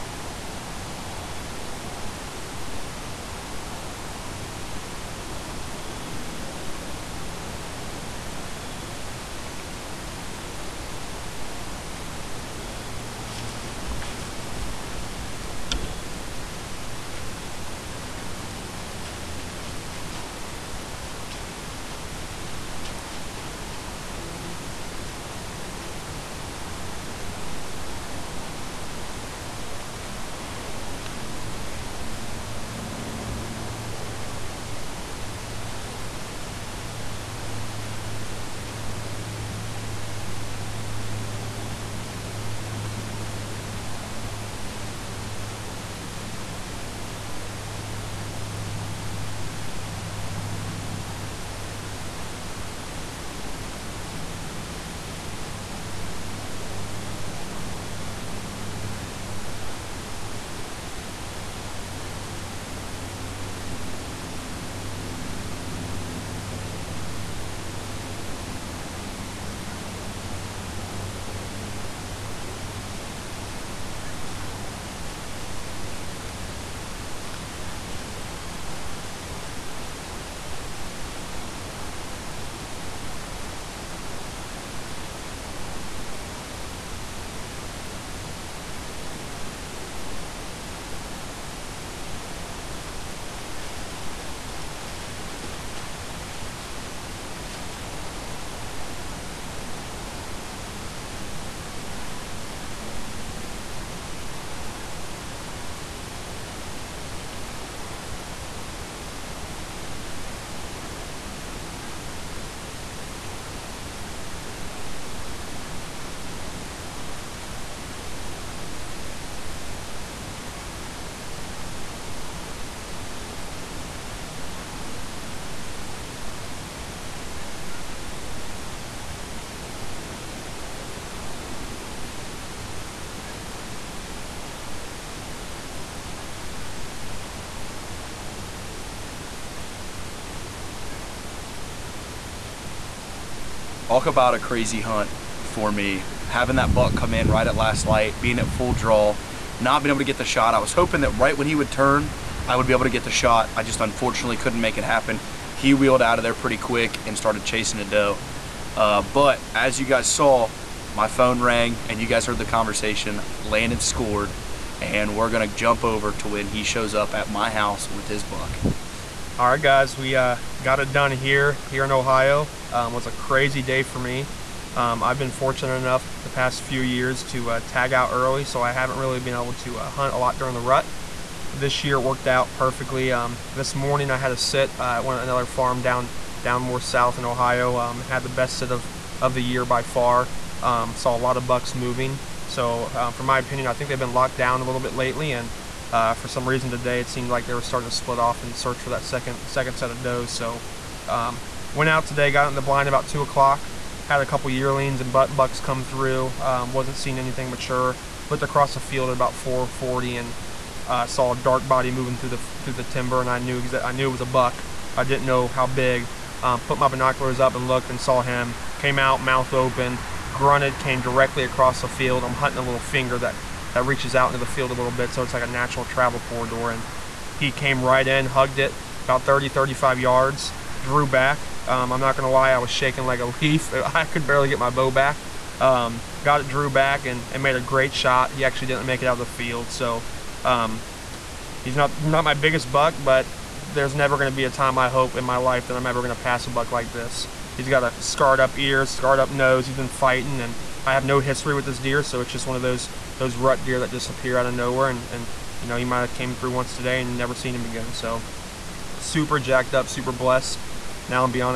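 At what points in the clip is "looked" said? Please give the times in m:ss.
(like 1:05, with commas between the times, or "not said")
3:28, 3:37.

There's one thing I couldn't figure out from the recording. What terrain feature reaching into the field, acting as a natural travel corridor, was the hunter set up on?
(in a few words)
A little finger.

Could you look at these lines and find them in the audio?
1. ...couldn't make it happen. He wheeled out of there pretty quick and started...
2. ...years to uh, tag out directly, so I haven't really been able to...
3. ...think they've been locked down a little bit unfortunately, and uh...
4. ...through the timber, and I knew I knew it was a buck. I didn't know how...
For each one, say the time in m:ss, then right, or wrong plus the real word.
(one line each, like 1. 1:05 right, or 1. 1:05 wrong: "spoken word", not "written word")
1. 2:34 right
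2. 2:56 wrong: "early", not "directly"
3. 3:13 wrong: "lately", not "unfortunately"
4. 3:32 right.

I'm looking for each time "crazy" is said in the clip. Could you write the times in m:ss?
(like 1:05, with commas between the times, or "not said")
2:24, 2:53.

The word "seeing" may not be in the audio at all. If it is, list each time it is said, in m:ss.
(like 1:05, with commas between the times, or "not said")
3:26.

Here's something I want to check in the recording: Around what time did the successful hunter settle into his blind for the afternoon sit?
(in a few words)
2 o'clock.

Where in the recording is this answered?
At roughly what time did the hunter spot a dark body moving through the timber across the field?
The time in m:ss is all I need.
3:29.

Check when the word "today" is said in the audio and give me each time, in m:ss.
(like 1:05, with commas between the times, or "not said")
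3:16, 3:22, 4:16.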